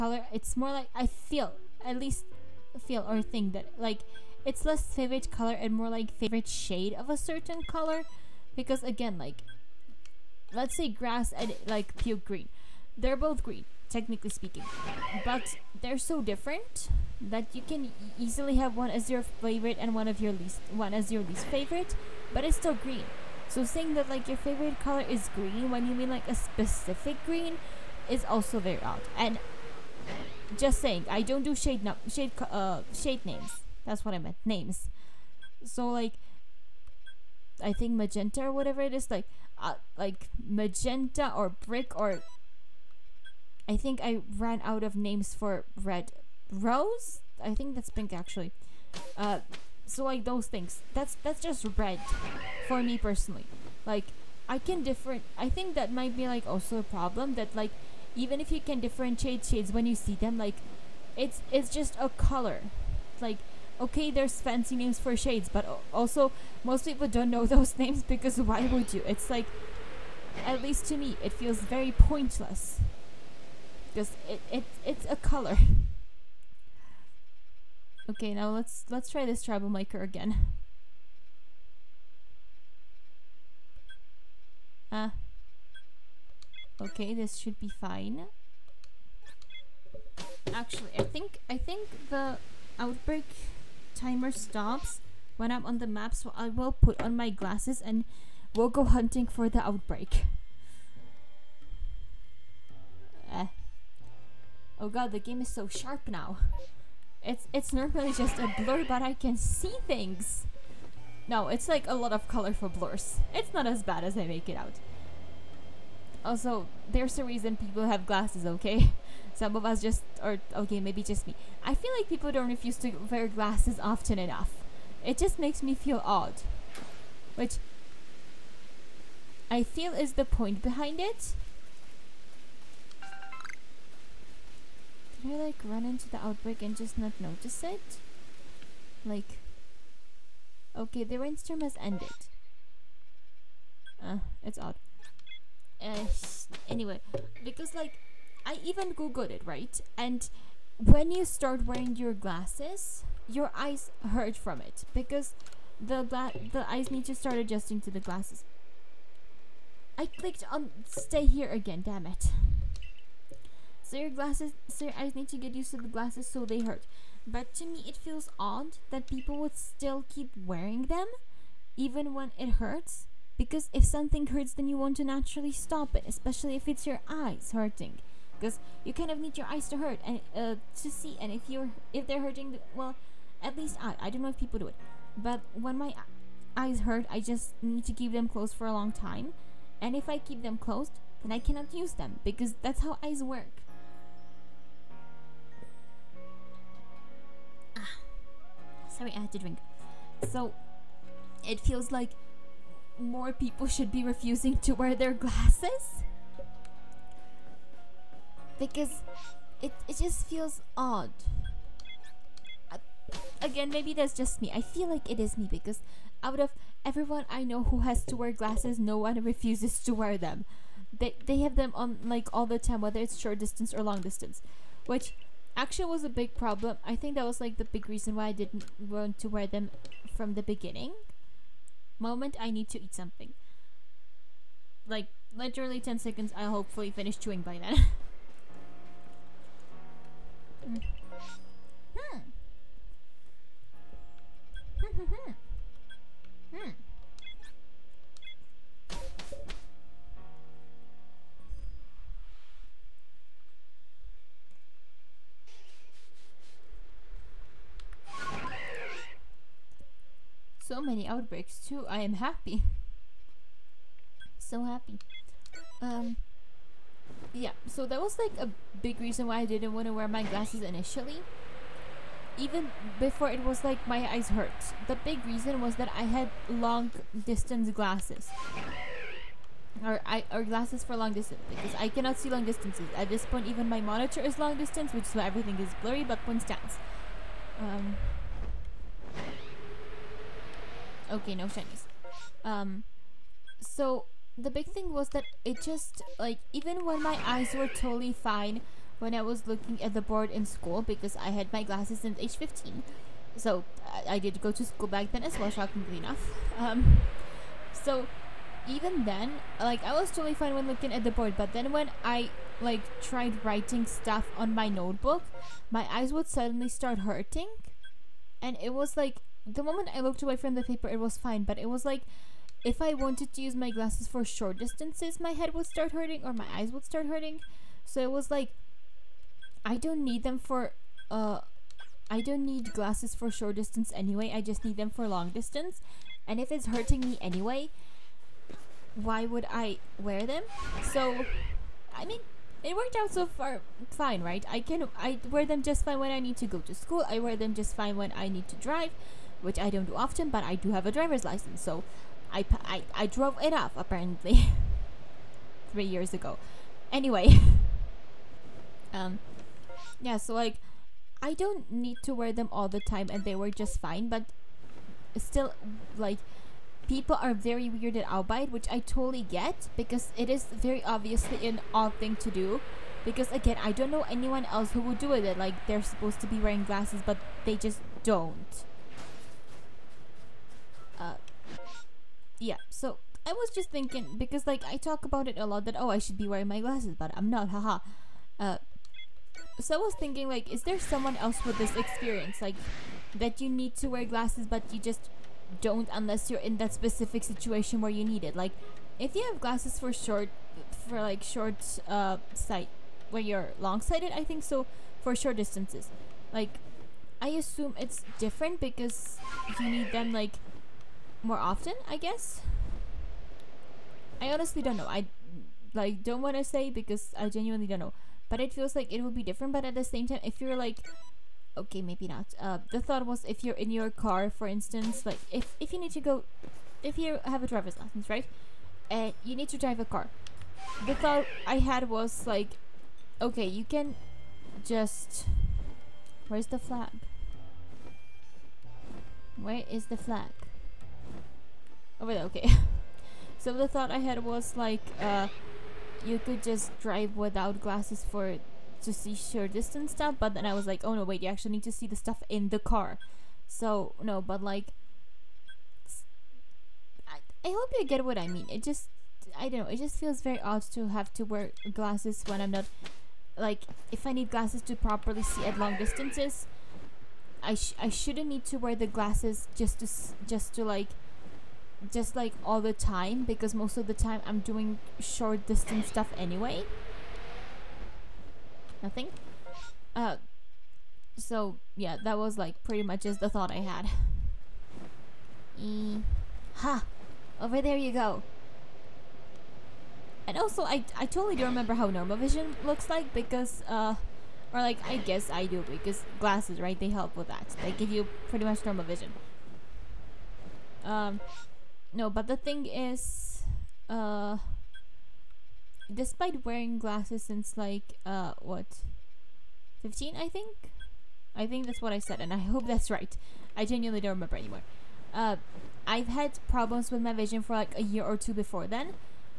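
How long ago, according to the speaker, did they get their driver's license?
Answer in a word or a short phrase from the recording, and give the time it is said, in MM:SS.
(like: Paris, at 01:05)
3 years, at 05:55.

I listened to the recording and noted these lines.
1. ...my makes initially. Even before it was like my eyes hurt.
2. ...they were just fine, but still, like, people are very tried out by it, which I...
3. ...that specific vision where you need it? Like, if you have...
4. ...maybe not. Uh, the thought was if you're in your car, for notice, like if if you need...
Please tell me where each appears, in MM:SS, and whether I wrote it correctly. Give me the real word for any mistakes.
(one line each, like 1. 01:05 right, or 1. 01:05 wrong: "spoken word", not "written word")
1. 04:30 wrong: "glasses", not "makes"
2. 06:03 wrong: "weirded", not "tried"
3. 06:36 wrong: "situation", not "vision"
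4. 07:01 wrong: "instance", not "notice".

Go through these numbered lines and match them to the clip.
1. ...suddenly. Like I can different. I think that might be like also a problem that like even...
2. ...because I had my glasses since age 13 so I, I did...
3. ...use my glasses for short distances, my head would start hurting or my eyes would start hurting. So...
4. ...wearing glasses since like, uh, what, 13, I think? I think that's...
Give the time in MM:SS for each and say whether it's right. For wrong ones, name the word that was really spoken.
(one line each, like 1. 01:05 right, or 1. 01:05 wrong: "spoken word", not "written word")
1. 00:52 wrong: "personally", not "suddenly"
2. 05:00 wrong: "15", not "13"
3. 05:23 right
4. 08:26 wrong: "15", not "13".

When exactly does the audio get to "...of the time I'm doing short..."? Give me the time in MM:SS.
07:53.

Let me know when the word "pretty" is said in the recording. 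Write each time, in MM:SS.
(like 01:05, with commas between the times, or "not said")
08:02, 08:18.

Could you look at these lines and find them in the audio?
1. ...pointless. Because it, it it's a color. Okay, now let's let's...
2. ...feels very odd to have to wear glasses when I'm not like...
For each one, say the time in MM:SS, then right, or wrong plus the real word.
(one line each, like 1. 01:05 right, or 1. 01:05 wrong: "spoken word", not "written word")
1. 01:11 right
2. 07:39 right.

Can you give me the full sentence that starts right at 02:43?
So your glasses, so your eyes need to get used to the glasses so they hurt.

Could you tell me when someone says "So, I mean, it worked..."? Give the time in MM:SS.
05:40.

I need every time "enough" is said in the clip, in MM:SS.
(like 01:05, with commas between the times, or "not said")
02:04, 05:05.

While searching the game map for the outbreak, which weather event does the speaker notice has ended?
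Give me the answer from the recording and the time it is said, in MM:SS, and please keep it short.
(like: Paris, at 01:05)
rainstorm, at 02:21.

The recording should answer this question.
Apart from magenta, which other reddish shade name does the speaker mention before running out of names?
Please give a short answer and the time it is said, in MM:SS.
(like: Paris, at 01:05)
brick, at 00:41.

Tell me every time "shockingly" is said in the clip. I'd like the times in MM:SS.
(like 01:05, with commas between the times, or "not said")
05:05.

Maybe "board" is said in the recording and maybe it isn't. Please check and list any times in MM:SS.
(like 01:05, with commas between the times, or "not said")
05:00, 05:11.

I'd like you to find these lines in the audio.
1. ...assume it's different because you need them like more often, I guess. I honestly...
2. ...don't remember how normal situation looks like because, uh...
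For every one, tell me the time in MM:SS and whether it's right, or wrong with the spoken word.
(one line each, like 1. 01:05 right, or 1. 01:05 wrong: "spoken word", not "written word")
1. 06:47 right
2. 08:11 wrong: "vision", not "situation".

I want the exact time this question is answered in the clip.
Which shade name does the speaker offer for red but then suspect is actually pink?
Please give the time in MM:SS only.
00:46.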